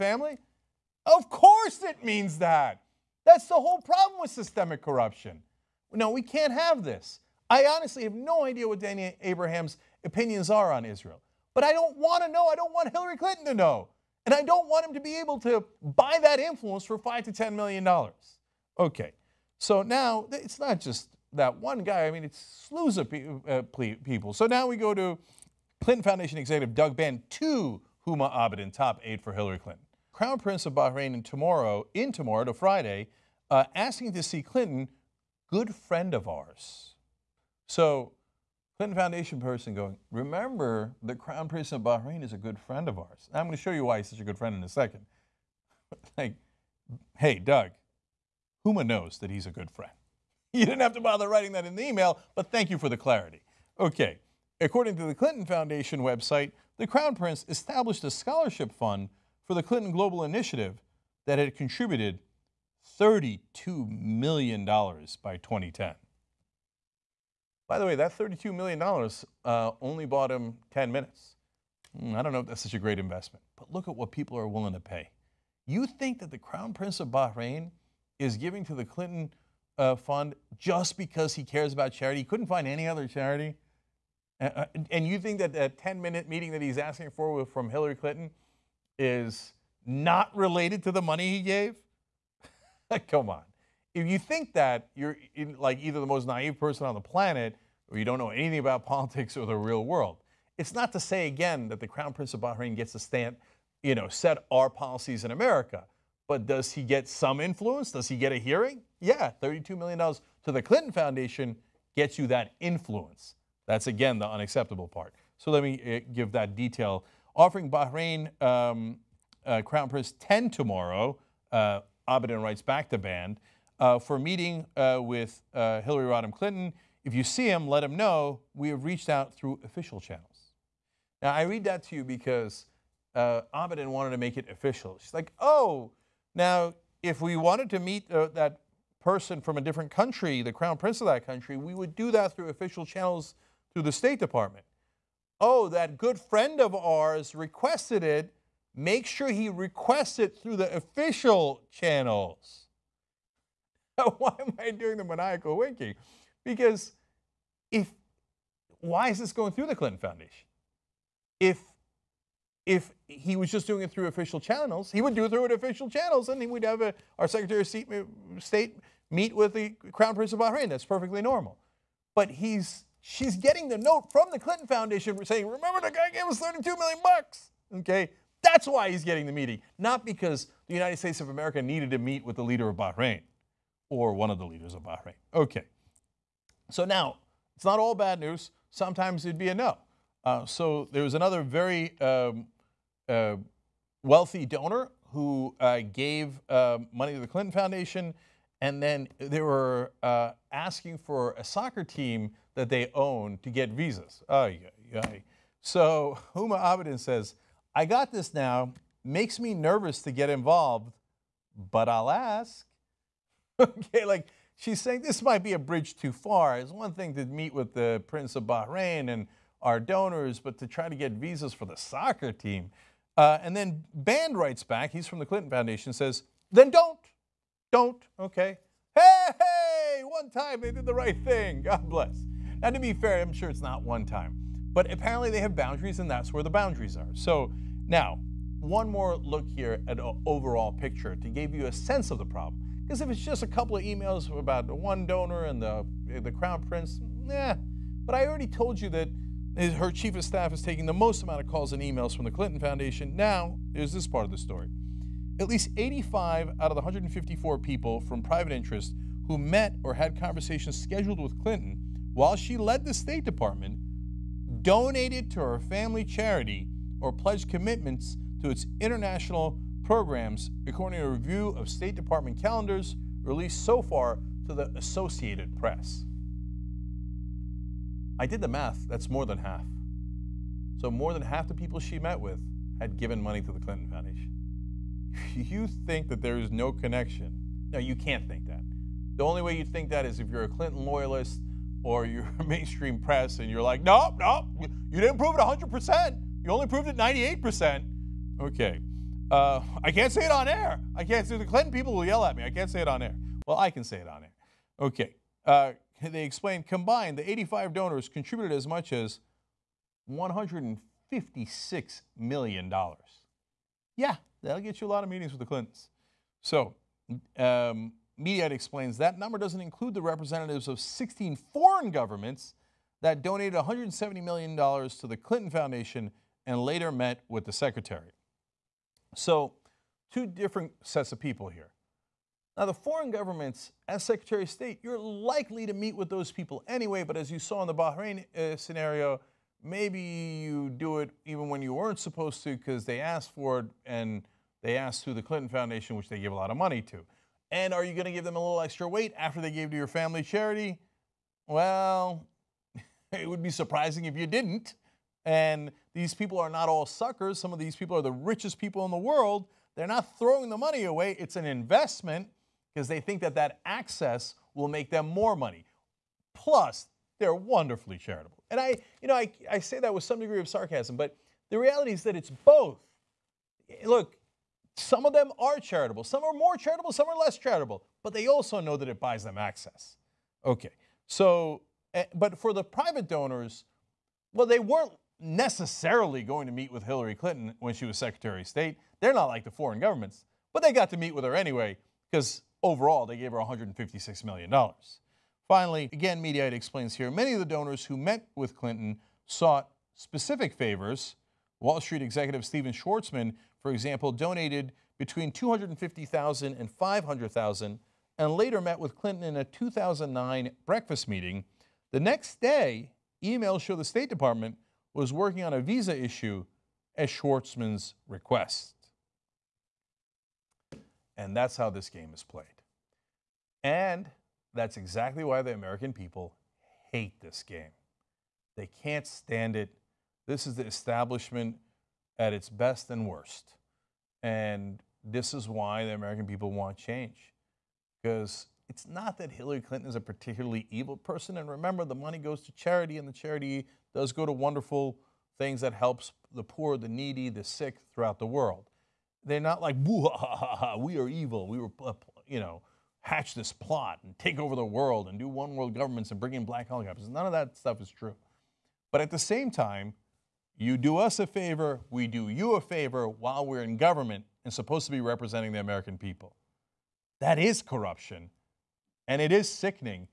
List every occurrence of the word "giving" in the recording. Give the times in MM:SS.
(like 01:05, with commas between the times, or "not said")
01:18.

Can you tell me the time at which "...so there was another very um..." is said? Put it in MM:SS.
03:10.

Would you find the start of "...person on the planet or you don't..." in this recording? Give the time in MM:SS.
01:36.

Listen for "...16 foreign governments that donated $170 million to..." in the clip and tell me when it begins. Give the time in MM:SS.
05:20.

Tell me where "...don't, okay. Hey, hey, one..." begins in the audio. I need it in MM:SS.
03:47.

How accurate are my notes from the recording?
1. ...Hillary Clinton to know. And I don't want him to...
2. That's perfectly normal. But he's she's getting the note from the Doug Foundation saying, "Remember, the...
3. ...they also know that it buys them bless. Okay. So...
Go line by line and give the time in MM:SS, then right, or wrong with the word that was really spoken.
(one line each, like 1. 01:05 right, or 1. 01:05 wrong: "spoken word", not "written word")
1. 00:12 right
2. 02:50 wrong: "Clinton", not "Doug"
3. 06:18 wrong: "access", not "bless".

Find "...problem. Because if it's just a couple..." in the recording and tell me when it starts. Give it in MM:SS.
04:02.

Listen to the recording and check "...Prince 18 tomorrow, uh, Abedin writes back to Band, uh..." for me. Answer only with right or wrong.
wrong.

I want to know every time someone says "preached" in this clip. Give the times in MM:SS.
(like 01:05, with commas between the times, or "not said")
not said.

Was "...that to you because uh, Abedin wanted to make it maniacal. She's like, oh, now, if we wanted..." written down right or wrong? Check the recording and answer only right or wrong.
wrong.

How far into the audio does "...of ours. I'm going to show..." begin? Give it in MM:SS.
00:42.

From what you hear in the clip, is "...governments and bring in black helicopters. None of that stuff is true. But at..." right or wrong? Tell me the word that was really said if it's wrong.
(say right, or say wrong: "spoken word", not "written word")
right.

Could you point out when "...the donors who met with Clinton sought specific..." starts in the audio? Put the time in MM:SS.
06:37.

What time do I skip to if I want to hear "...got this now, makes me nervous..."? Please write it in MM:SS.
03:27.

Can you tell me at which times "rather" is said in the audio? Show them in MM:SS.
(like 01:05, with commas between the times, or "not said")
not said.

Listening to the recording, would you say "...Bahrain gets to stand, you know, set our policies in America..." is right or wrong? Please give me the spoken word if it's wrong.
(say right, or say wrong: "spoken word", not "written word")
right.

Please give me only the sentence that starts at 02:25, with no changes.
Oh, that good friend of ours requested it.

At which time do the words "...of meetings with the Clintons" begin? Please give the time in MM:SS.
05:15.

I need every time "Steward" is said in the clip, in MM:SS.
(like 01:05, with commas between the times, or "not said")
not said.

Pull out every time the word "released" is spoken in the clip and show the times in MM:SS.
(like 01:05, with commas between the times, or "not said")
04:33.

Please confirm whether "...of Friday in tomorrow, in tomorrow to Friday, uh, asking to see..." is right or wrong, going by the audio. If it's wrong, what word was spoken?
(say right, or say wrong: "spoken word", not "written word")
wrong: "Bahrain", not "Friday".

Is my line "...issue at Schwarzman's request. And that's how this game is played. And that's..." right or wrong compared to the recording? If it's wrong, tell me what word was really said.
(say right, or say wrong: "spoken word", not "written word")
right.